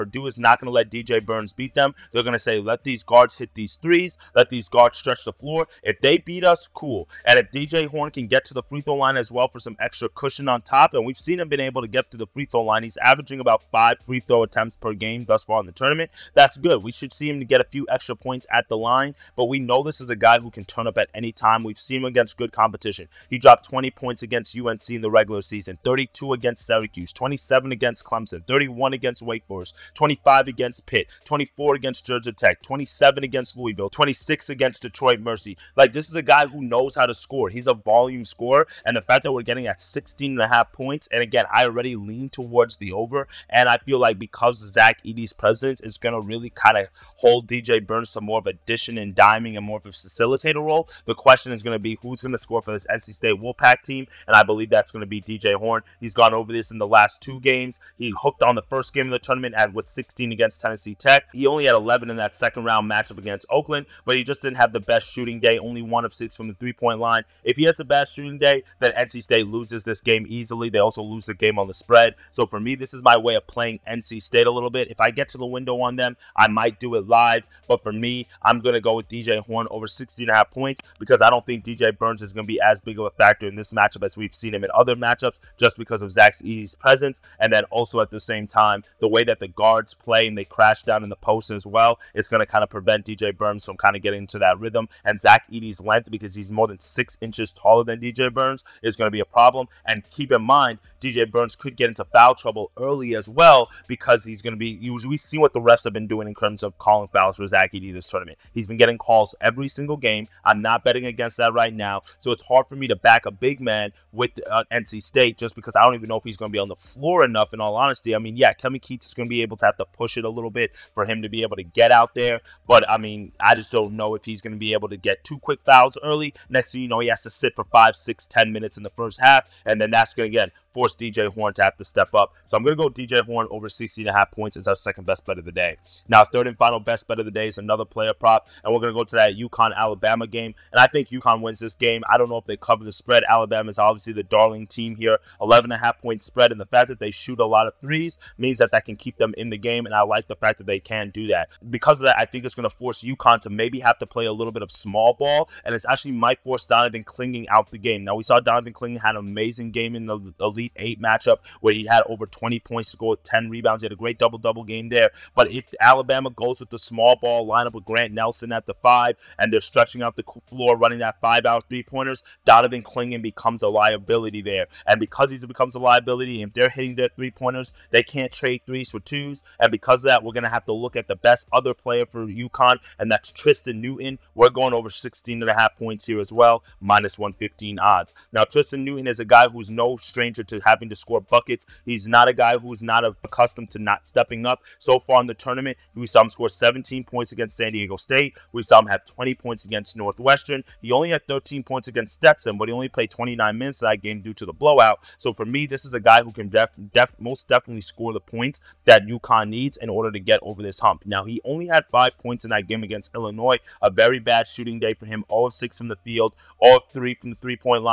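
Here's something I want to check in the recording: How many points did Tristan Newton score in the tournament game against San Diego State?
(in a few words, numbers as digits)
17.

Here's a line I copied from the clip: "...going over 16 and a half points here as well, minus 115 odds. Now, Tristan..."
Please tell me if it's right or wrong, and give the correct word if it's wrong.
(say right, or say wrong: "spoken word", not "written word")
right.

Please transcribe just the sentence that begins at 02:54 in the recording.
And because he becomes a liability, if they're hitting their three pointers, they can't trade threes for twos.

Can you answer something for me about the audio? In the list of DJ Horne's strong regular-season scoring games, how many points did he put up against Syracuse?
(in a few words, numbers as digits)
32.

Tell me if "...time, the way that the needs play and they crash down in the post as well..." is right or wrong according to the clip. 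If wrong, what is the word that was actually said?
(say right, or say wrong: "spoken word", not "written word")
wrong: "guards", not "needs".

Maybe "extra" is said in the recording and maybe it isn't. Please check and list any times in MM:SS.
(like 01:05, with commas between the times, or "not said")
00:09, 00:17.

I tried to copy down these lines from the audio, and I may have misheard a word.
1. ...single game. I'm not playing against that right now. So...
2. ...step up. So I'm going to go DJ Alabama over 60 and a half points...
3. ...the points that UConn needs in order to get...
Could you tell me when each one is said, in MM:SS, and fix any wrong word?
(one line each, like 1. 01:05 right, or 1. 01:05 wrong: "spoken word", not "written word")
1. 01:49 wrong: "betting", not "playing"
2. 02:11 wrong: "Horne", not "Alabama"
3. 03:28 right.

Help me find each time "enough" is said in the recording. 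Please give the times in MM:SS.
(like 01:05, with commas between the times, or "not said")
01:57.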